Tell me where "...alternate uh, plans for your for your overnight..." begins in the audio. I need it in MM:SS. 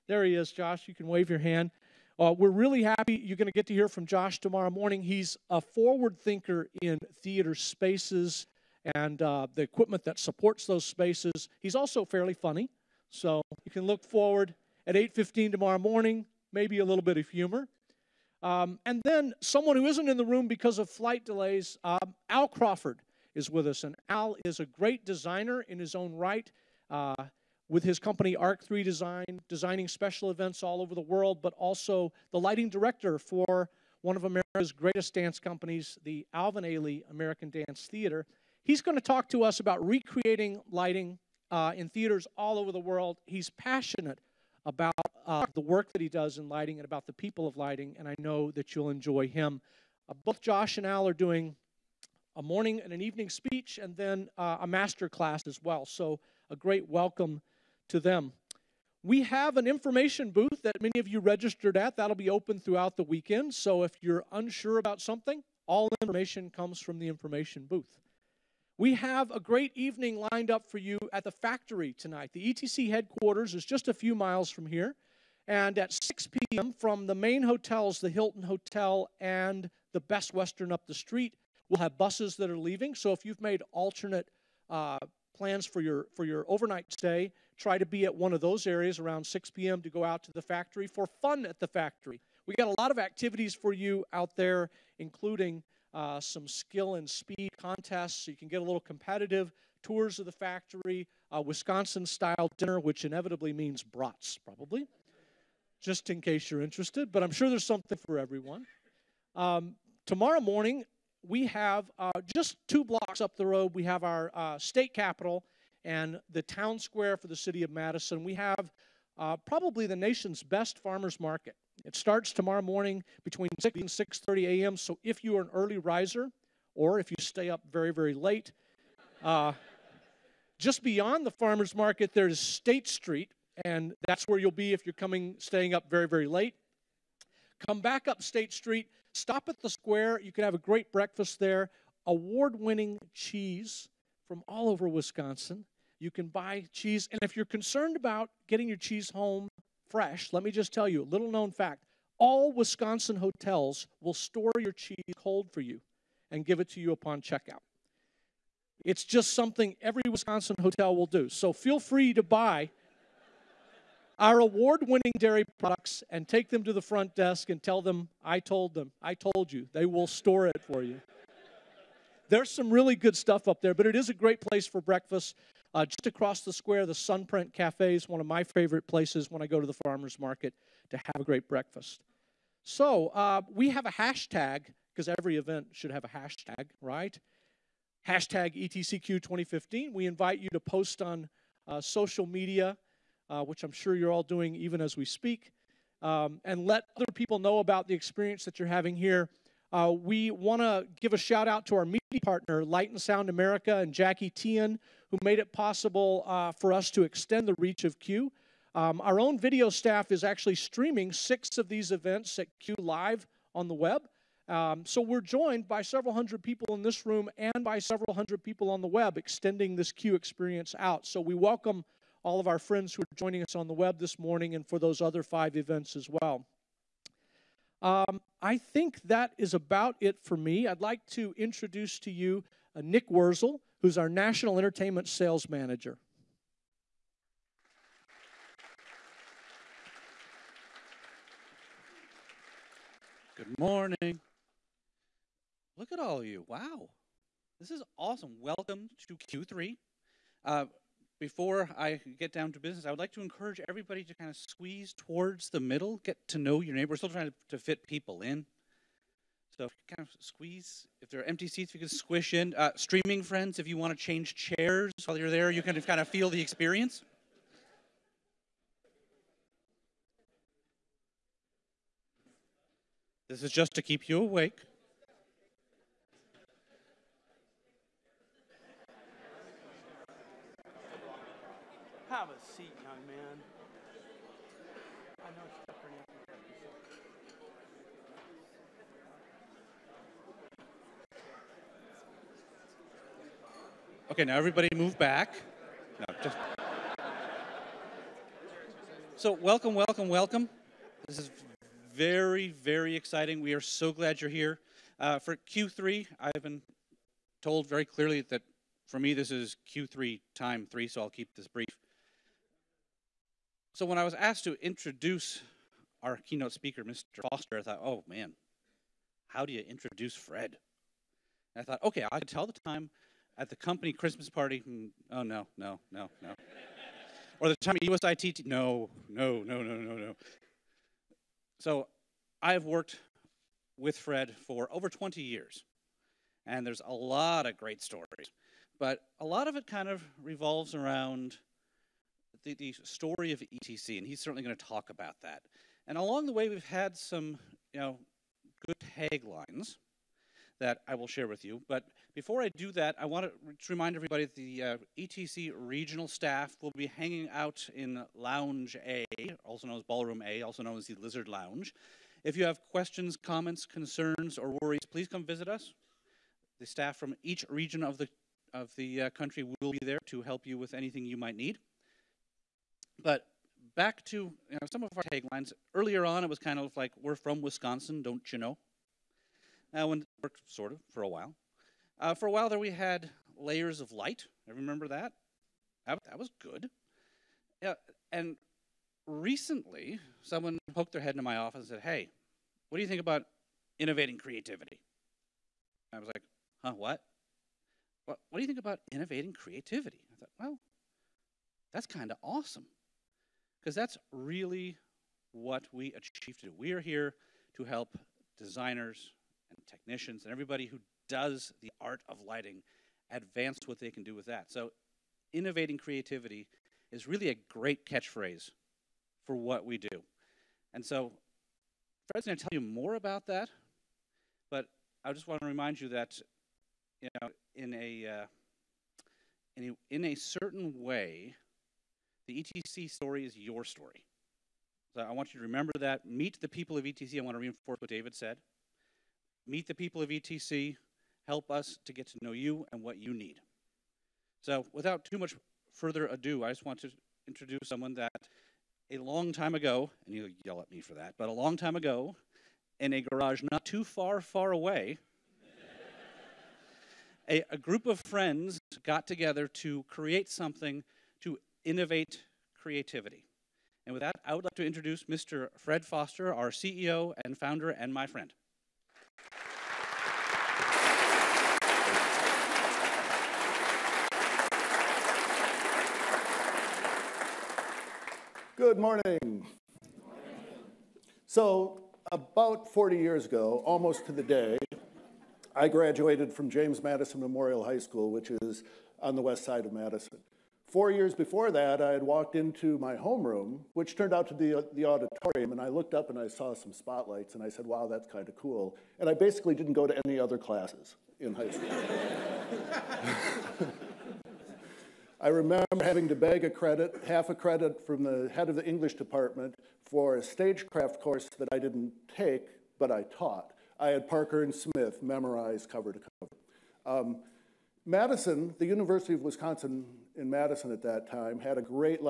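01:23.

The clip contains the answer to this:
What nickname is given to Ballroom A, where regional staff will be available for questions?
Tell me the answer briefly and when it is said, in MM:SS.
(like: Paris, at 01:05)
Lizard Lounge, at 06:00.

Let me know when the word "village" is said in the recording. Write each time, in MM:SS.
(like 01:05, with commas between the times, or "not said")
not said.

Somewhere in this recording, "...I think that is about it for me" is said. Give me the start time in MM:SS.
03:48.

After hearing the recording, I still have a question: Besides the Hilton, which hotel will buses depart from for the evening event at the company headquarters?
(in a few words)
Best Western.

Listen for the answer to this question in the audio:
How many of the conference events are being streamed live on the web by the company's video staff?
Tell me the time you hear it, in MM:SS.
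03:31.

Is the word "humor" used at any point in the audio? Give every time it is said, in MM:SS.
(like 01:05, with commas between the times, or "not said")
00:17.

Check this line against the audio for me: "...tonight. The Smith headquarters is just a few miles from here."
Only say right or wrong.
wrong.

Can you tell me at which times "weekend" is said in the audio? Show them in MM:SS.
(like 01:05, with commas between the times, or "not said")
01:03.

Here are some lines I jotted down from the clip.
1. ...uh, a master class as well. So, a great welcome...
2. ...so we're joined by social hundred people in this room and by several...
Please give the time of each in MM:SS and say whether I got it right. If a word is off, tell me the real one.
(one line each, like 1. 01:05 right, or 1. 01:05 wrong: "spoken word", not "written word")
1. 00:54 right
2. 03:34 wrong: "several", not "social".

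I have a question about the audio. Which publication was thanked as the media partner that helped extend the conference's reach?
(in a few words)
Light and Sound America.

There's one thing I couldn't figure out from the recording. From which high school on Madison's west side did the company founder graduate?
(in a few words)
James Madison Memorial High School.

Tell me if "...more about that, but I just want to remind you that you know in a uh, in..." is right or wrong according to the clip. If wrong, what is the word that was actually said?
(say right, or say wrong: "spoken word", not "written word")
right.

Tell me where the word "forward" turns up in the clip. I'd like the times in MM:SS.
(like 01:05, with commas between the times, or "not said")
00:05, 00:14.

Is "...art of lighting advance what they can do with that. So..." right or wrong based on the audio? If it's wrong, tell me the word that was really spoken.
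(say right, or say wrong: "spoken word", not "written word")
right.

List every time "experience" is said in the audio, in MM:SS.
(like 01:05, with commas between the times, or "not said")
03:17, 03:40, 04:26.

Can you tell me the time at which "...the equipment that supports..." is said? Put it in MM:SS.
00:09.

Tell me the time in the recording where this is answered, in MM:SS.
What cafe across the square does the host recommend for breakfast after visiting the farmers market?
02:56.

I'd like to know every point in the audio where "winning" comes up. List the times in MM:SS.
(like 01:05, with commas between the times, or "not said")
02:22, 02:44.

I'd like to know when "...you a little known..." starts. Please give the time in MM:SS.
02:30.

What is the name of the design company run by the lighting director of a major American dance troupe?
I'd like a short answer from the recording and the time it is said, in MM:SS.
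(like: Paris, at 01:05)
Arc3 Design, at 00:28.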